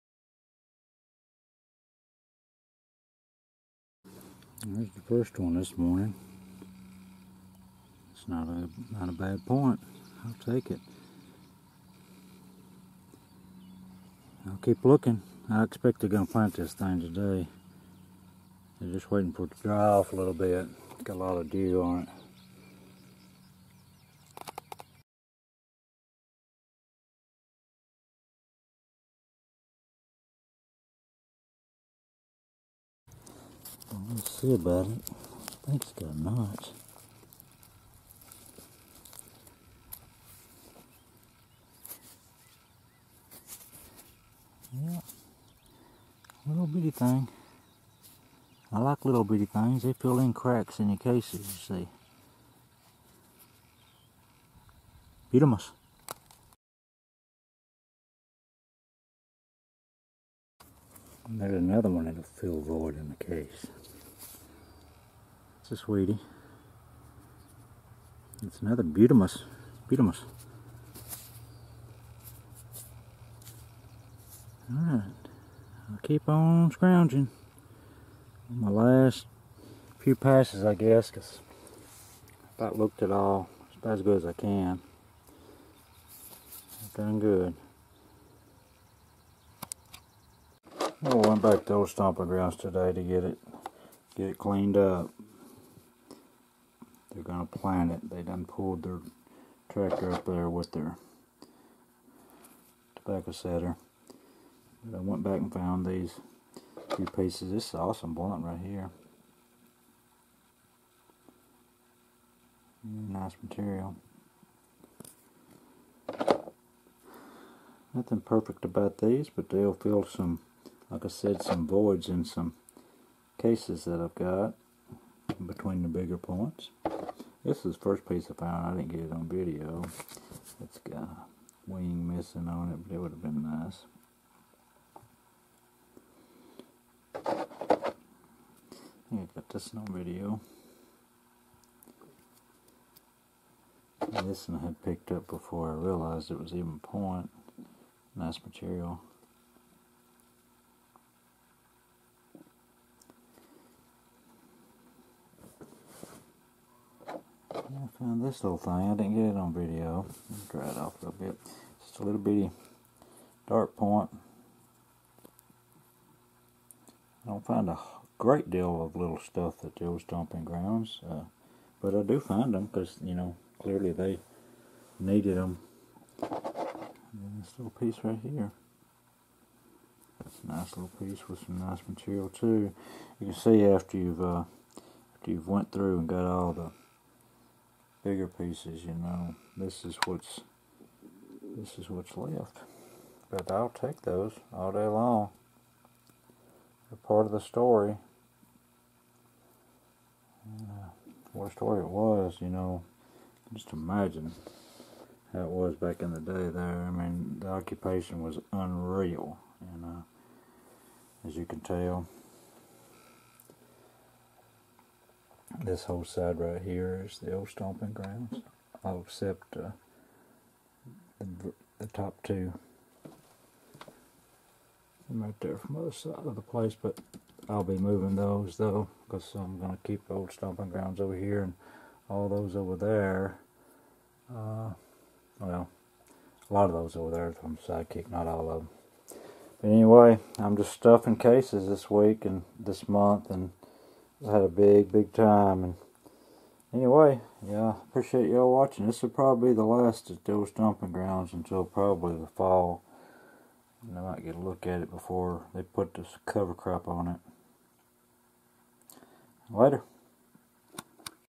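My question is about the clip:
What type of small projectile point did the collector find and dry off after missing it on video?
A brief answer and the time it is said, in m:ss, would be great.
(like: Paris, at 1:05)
Dart point, at 2:43.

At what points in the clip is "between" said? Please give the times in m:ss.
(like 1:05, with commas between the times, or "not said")
2:05.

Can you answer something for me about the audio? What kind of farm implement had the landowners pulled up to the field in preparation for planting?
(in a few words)
Tobacco setter.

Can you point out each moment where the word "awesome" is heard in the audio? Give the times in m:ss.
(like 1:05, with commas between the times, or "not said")
1:47.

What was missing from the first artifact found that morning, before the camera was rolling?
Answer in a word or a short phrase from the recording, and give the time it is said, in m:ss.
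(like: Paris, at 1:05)
A wing, at 2:11.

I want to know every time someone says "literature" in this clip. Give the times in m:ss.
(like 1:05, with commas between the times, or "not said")
not said.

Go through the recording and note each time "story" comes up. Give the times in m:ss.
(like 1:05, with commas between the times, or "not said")
3:17, 3:21.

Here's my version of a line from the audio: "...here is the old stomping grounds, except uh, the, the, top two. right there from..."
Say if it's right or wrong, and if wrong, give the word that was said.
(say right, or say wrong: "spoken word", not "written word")
right.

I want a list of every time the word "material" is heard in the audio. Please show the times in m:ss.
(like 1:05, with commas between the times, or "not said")
1:53, 2:28, 3:01.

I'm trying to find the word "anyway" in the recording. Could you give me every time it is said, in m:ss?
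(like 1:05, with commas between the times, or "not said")
3:59, 4:06.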